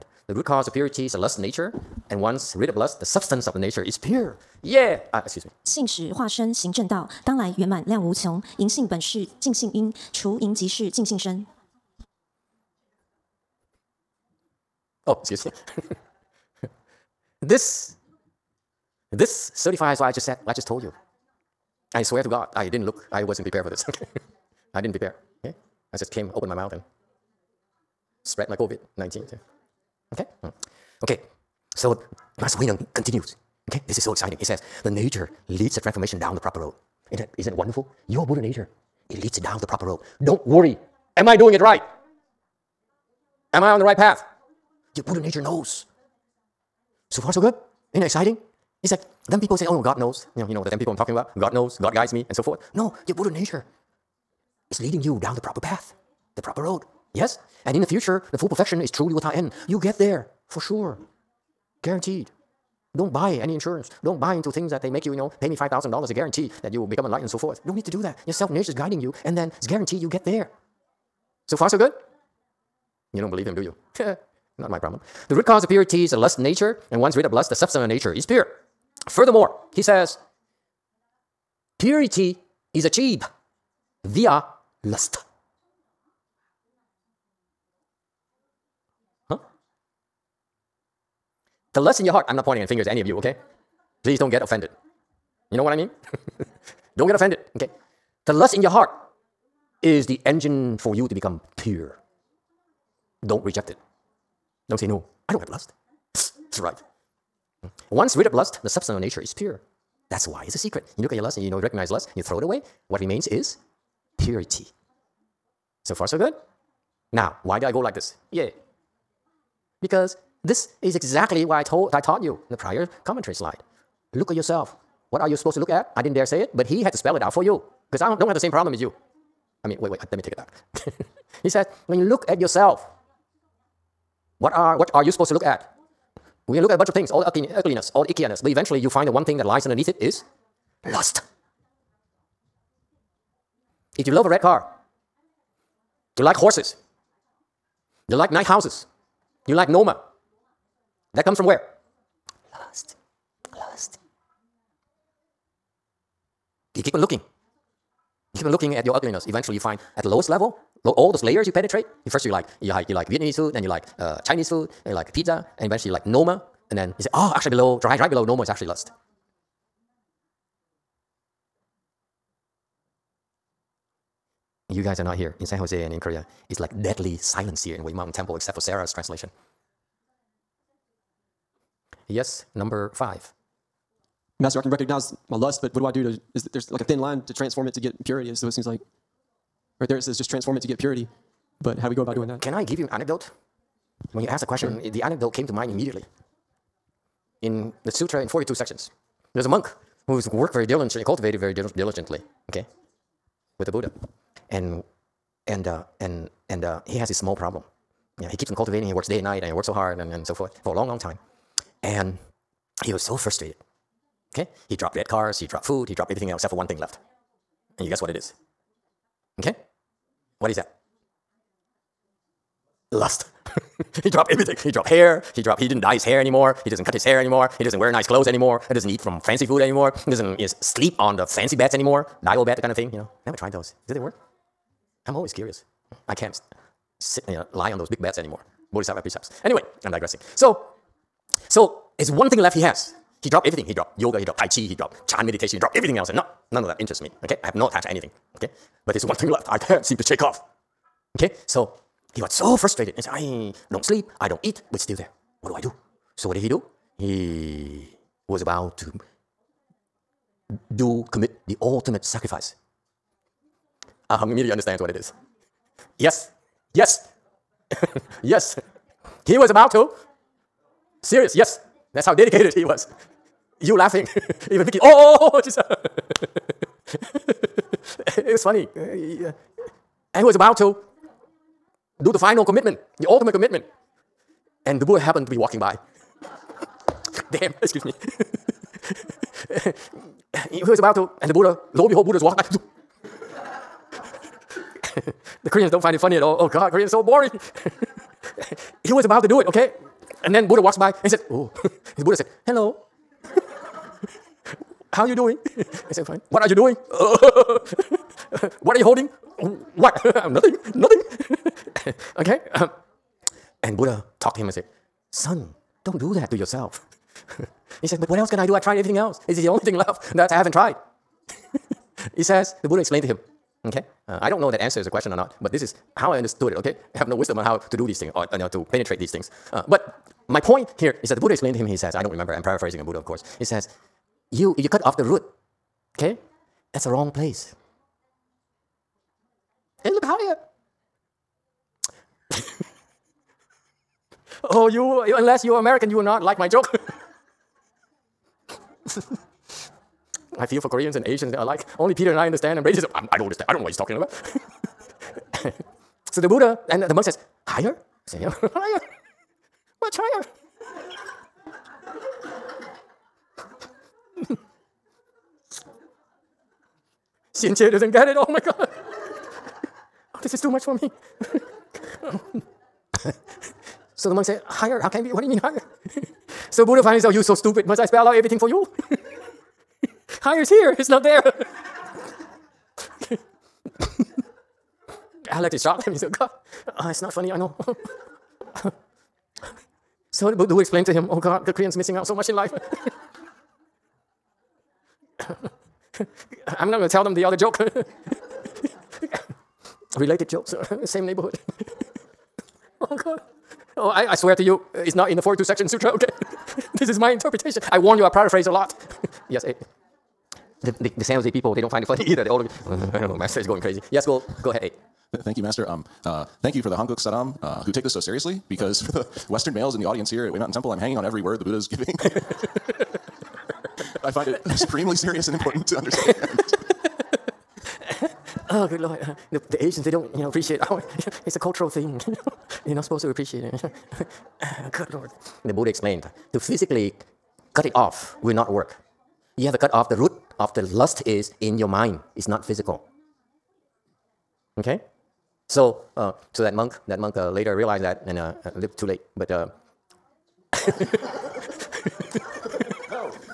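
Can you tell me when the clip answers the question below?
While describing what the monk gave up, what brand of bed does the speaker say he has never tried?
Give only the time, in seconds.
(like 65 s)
232 s.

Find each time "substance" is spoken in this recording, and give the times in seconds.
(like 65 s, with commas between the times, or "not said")
3 s, 77 s, 108 s.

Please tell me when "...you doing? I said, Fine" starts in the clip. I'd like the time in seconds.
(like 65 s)
305 s.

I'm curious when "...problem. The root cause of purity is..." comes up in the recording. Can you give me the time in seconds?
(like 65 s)
74 s.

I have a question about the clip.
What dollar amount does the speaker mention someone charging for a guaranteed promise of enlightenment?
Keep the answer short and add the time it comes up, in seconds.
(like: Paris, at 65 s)
$5,000, at 65 s.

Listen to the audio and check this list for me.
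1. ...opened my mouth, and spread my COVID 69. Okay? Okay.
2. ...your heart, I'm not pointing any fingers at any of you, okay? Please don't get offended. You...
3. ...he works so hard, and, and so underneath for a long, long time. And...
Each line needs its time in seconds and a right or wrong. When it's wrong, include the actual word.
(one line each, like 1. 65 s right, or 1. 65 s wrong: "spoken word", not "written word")
1. 26 s wrong: "19", not "69"
2. 92 s right
3. 209 s wrong: "forth", not "underneath".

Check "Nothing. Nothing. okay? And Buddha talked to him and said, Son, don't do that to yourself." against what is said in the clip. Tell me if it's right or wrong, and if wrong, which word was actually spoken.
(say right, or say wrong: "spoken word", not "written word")
right.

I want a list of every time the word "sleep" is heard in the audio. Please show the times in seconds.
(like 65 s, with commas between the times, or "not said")
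230 s, 253 s.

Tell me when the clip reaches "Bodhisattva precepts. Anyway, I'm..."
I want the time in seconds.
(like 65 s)
238 s.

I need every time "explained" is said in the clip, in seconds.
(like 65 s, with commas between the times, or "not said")
322 s, 331 s, 390 s, 435 s.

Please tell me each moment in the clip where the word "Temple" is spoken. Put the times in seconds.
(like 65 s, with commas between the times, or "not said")
178 s, 420 s.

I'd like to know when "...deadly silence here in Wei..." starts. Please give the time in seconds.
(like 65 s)
176 s.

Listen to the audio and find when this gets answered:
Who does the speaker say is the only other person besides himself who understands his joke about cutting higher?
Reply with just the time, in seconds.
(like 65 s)
351 s.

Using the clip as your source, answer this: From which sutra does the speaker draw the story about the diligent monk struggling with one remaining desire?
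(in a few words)
Sutra in 42 Sections.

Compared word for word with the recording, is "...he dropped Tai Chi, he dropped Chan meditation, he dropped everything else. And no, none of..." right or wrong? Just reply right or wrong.
right.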